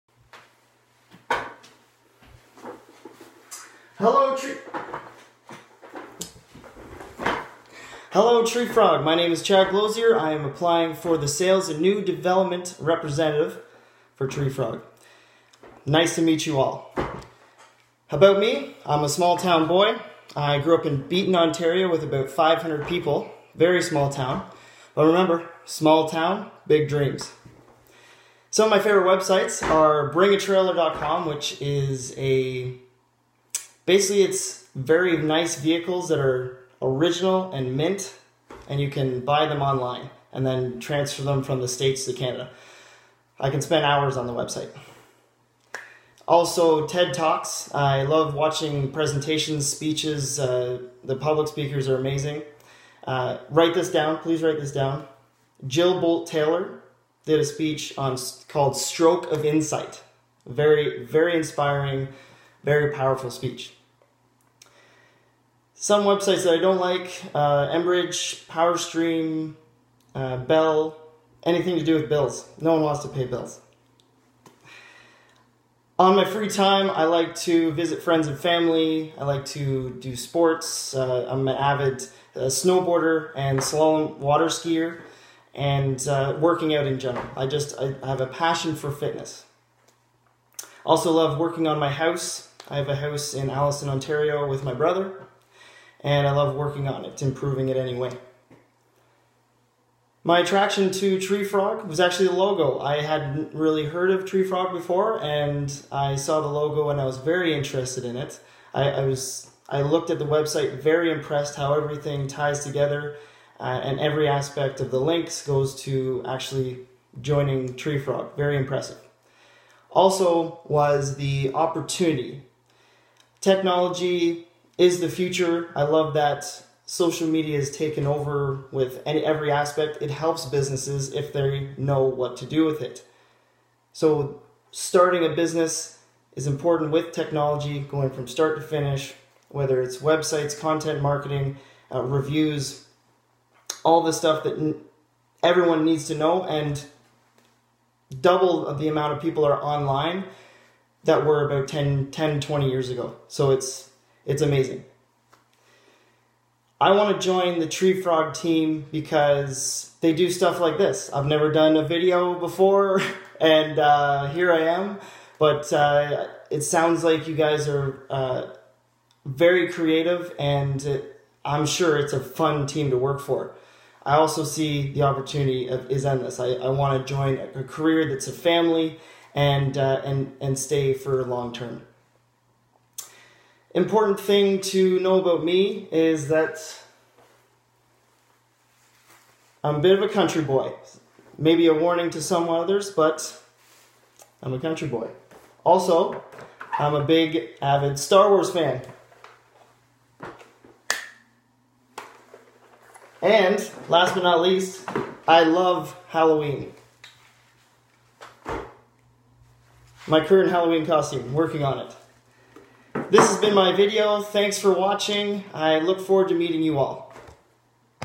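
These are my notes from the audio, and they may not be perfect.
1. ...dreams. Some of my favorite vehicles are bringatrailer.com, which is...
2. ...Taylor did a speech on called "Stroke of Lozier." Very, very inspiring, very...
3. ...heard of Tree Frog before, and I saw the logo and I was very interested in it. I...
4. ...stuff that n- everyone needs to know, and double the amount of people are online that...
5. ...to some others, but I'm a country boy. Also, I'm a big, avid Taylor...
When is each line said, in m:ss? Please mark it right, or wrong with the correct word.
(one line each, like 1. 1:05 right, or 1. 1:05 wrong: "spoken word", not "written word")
1. 0:26 wrong: "websites", not "vehicles"
2. 0:56 wrong: "Insight", not "Lozier"
3. 1:43 right
4. 2:24 right
5. 3:12 wrong: "Star", not "Taylor".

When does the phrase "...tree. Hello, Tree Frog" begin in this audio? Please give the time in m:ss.
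0:04.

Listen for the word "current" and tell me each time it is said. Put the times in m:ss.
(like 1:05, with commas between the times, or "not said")
3:30.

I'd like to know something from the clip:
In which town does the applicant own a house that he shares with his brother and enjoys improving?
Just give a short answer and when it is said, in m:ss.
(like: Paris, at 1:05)
Alliston, Ontario, at 1:33.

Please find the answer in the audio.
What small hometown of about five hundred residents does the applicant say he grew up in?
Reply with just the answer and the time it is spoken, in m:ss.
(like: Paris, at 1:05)
Beeton, Ontario, at 0:21.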